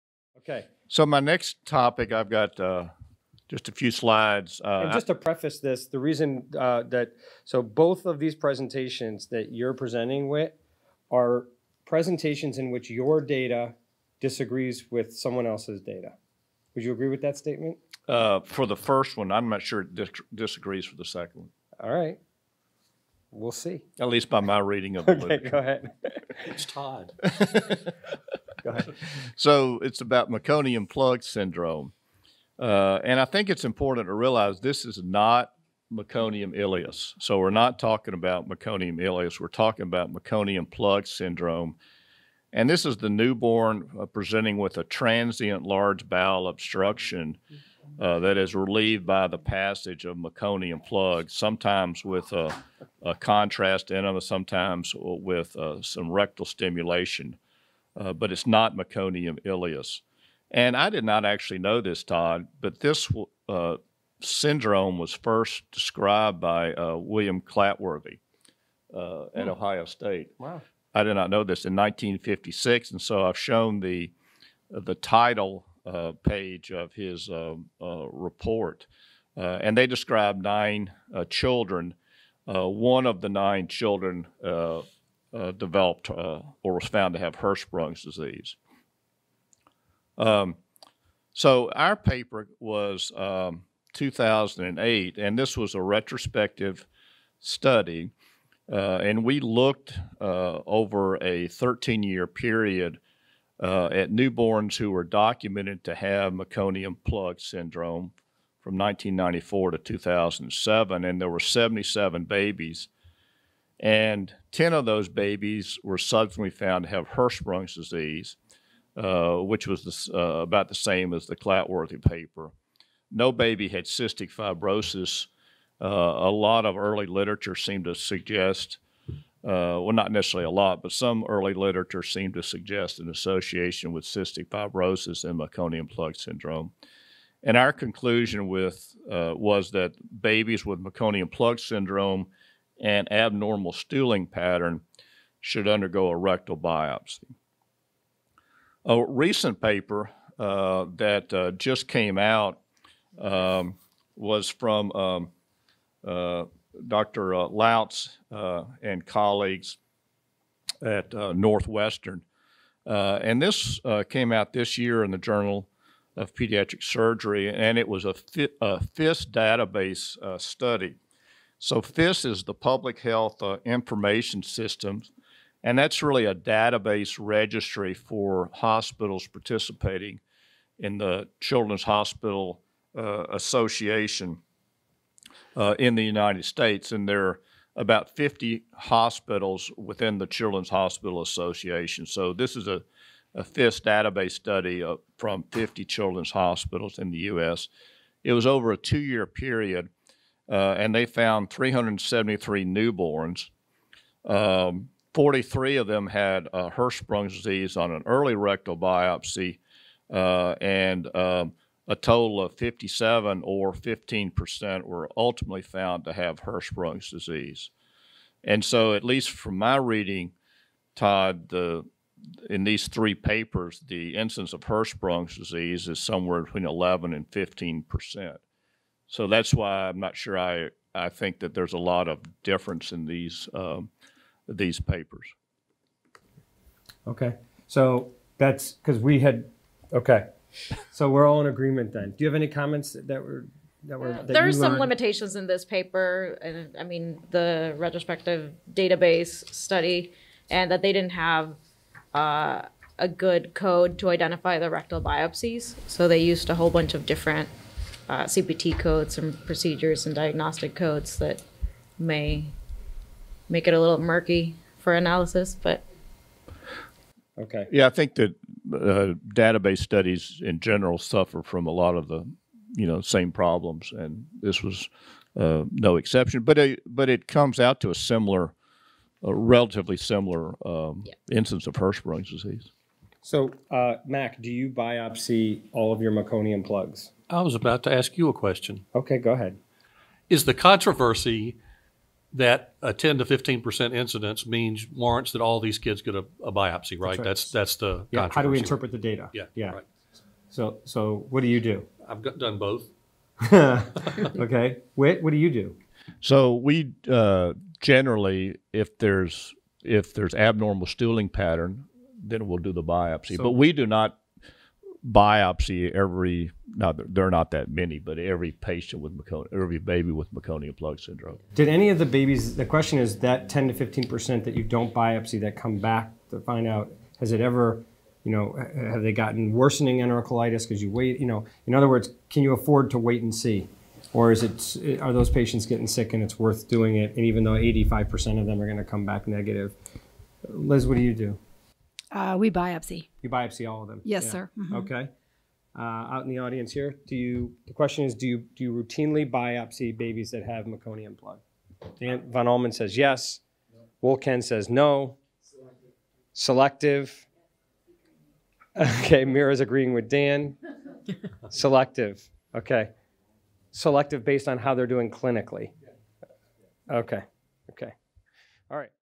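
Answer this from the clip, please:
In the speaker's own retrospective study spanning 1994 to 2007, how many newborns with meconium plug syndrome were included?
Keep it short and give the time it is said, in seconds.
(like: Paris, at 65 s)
77, at 111 s.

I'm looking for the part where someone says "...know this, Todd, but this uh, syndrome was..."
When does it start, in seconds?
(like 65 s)
61 s.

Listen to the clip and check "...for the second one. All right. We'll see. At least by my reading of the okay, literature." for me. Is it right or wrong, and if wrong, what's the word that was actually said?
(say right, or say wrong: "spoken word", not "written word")
right.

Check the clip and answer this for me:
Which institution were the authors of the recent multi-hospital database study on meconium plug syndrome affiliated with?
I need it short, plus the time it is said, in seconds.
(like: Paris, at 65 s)
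Northwestern, at 161 s.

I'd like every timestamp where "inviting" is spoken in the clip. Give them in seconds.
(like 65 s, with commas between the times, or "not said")
not said.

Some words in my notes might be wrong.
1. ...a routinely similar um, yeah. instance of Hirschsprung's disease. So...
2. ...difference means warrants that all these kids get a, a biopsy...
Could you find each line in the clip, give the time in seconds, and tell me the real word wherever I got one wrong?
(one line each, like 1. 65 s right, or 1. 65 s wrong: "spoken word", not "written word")
1. 279 s wrong: "relatively", not "routinely"
2. 293 s wrong: "incidence", not "difference".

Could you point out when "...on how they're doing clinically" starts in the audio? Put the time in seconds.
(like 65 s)
364 s.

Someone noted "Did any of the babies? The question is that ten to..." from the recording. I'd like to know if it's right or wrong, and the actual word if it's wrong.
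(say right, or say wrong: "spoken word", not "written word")
right.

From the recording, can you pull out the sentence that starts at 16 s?
Would you agree with that statement?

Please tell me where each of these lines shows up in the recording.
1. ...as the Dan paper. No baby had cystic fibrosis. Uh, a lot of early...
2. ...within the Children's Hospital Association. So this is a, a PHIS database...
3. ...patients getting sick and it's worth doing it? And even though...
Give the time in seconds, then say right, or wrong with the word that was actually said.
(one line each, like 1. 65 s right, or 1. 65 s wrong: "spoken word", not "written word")
1. 121 s wrong: "Clatworthy", not "Dan"
2. 189 s right
3. 335 s right.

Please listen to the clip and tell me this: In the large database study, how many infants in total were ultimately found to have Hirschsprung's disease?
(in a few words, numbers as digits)
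57.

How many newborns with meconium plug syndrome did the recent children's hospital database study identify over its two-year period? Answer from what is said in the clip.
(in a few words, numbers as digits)
373.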